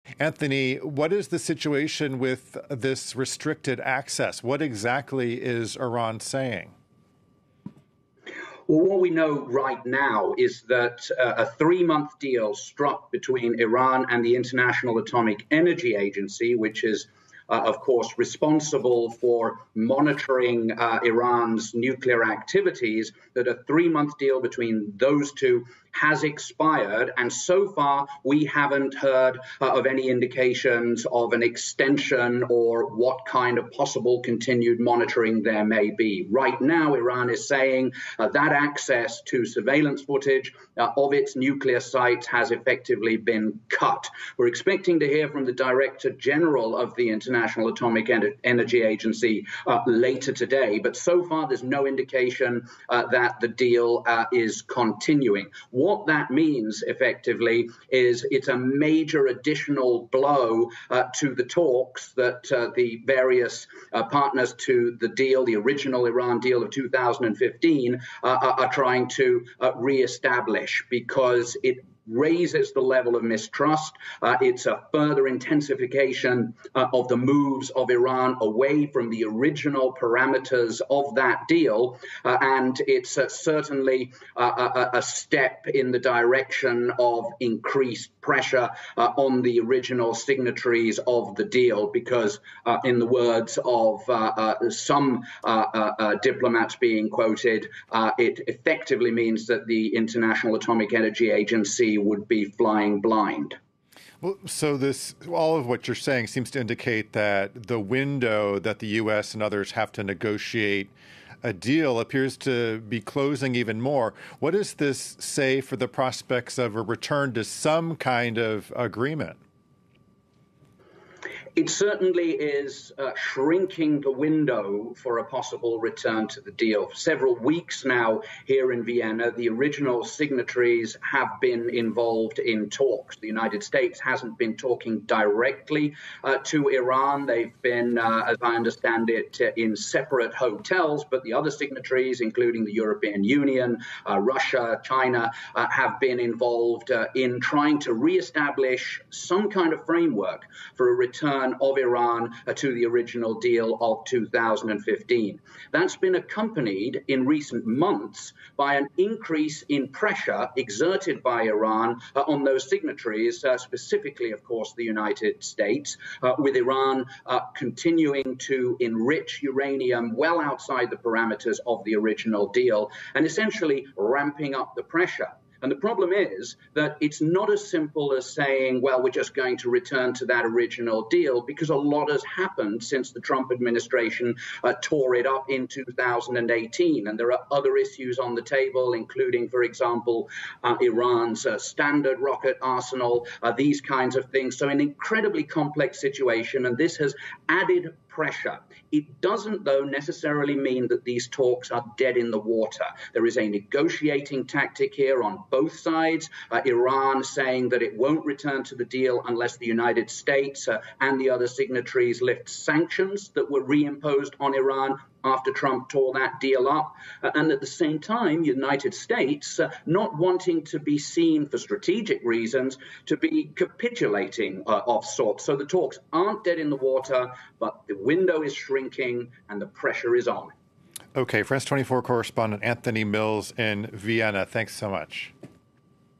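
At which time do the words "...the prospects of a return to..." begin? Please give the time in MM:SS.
01:55.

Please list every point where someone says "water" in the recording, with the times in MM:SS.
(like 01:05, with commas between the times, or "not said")
03:22, 03:46.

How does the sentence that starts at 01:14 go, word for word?
Uh, it's a further intensification uh, of the moves of Iran away from the original parameters of that deal.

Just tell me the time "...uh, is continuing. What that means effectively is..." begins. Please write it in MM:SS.
00:54.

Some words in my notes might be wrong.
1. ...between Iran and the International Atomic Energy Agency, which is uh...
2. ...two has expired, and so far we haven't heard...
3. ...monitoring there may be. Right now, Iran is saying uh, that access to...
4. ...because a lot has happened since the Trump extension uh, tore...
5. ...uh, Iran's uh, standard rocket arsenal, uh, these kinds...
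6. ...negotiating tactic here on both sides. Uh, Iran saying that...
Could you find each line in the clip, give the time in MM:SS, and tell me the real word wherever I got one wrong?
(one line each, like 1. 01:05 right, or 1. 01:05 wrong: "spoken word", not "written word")
1. 00:13 right
2. 00:25 right
3. 00:34 right
4. 03:01 wrong: "administration", not "extension"
5. 03:10 right
6. 03:23 right.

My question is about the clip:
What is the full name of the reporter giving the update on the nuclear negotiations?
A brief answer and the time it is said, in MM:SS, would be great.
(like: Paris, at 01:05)
Anthony Mills, at 03:52.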